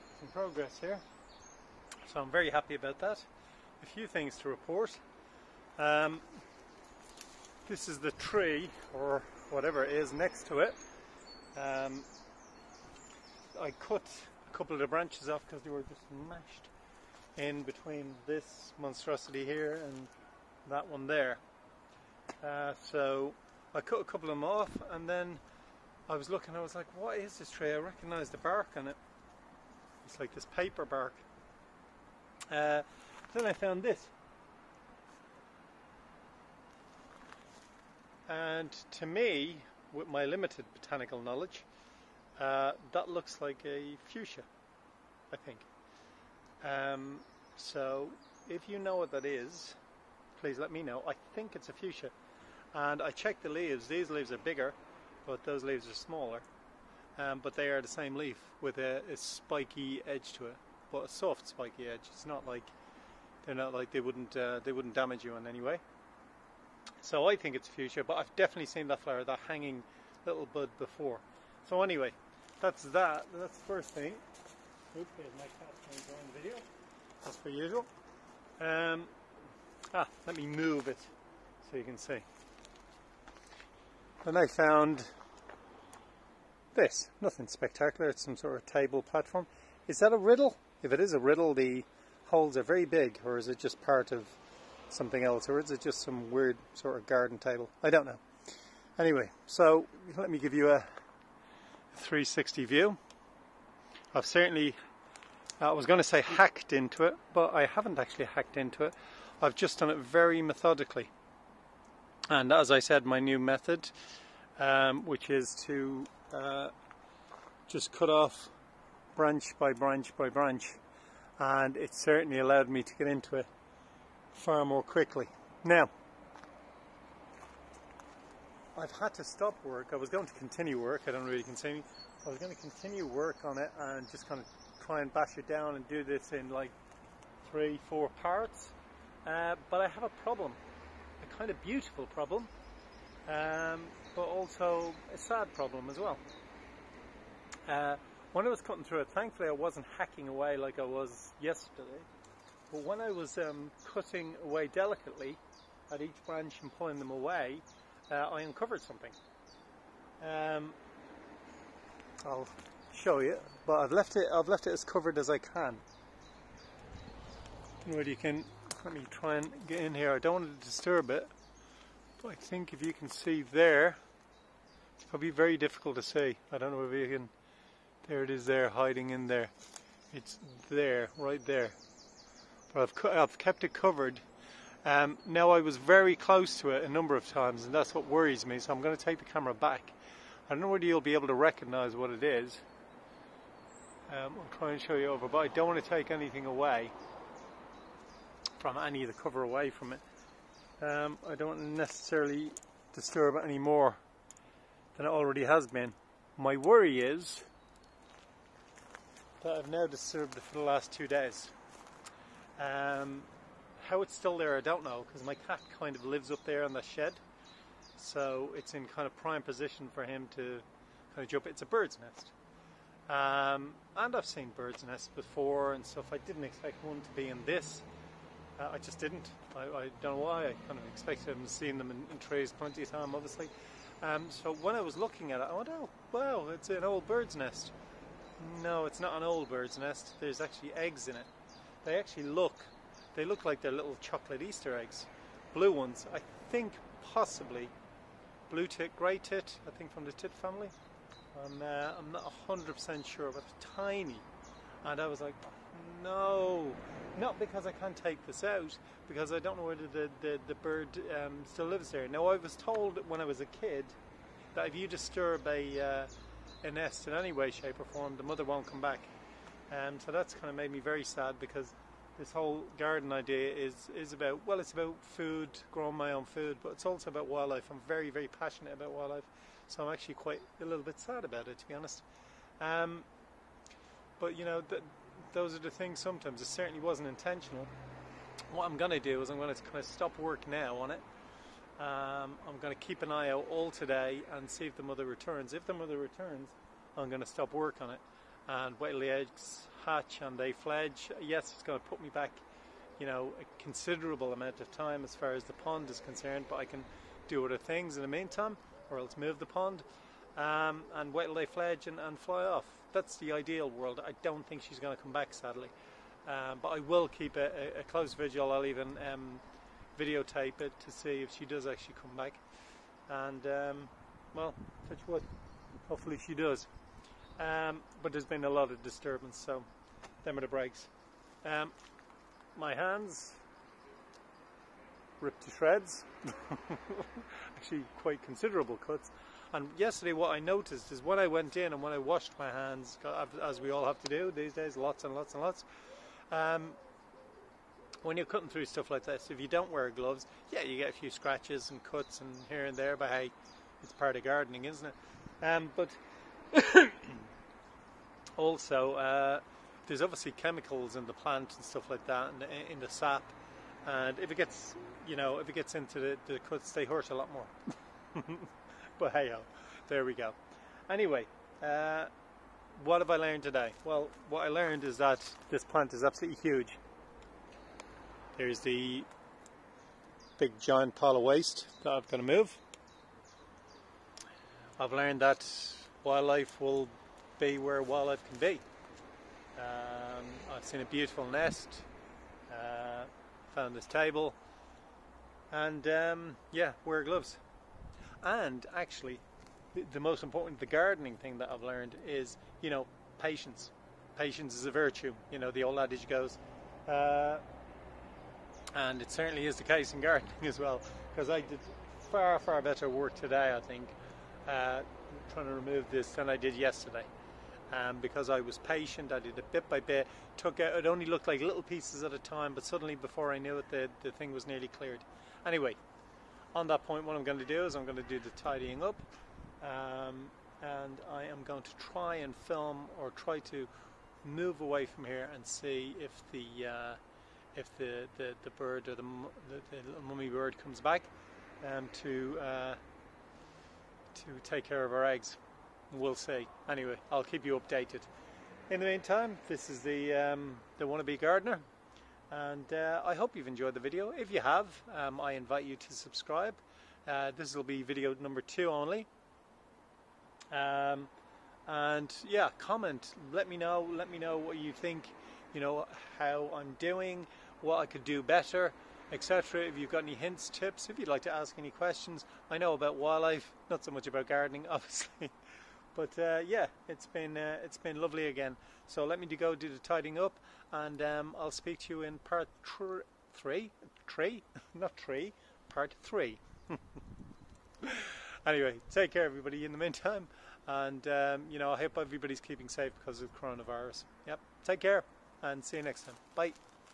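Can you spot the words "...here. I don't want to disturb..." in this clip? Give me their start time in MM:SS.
02:49.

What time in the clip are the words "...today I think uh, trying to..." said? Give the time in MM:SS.
06:53.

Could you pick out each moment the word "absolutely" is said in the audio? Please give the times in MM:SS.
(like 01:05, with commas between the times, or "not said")
06:16.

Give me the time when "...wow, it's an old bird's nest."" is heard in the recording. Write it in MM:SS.
03:56.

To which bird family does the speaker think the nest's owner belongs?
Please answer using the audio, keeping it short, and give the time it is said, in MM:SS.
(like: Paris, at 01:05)
tit family, at 04:10.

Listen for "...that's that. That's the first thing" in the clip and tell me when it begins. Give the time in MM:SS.
01:12.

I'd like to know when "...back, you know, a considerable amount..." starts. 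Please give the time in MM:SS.
05:02.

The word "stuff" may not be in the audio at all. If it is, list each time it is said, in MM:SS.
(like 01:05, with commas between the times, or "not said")
03:45, 05:48, 06:01.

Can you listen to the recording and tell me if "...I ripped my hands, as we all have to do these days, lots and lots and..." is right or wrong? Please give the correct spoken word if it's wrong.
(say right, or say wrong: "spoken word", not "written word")
wrong: "washed", not "ripped".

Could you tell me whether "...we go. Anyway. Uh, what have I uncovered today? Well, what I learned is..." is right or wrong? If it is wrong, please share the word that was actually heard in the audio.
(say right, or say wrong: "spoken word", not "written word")
wrong: "learned", not "uncovered".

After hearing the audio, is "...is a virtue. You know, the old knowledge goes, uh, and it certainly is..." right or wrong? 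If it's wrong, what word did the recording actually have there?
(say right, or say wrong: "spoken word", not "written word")
wrong: "adage", not "knowledge".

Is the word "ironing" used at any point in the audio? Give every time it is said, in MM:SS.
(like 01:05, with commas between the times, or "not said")
not said.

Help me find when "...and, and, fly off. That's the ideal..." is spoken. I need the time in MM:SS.
05:11.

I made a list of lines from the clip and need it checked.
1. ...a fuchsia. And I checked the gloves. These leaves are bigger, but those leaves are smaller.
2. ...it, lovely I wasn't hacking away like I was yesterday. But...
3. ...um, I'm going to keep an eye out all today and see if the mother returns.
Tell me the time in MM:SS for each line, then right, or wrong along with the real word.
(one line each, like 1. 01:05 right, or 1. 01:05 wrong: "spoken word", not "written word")
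1. 00:51 wrong: "leaves", not "gloves"
2. 02:29 wrong: "thankfully", not "lovely"
3. 04:51 right.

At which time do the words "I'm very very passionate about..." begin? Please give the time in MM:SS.
04:37.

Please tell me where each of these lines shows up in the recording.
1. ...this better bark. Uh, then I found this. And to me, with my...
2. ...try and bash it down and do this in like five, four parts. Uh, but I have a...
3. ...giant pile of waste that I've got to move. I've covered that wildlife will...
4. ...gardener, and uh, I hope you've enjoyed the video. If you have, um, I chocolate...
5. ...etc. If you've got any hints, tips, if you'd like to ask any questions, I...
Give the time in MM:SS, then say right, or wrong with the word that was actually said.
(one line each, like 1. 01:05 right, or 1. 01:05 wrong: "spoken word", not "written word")
1. 00:30 wrong: "paper", not "better"
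2. 02:14 wrong: "three", not "five"
3. 06:20 wrong: "learned", not "covered"
4. 07:31 wrong: "invite", not "chocolate"
5. 07:49 right.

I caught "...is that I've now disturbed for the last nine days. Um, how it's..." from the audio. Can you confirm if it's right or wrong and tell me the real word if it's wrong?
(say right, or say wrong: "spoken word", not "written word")
wrong: "two", not "nine".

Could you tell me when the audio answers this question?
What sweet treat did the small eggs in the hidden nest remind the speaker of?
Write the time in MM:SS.
04:04.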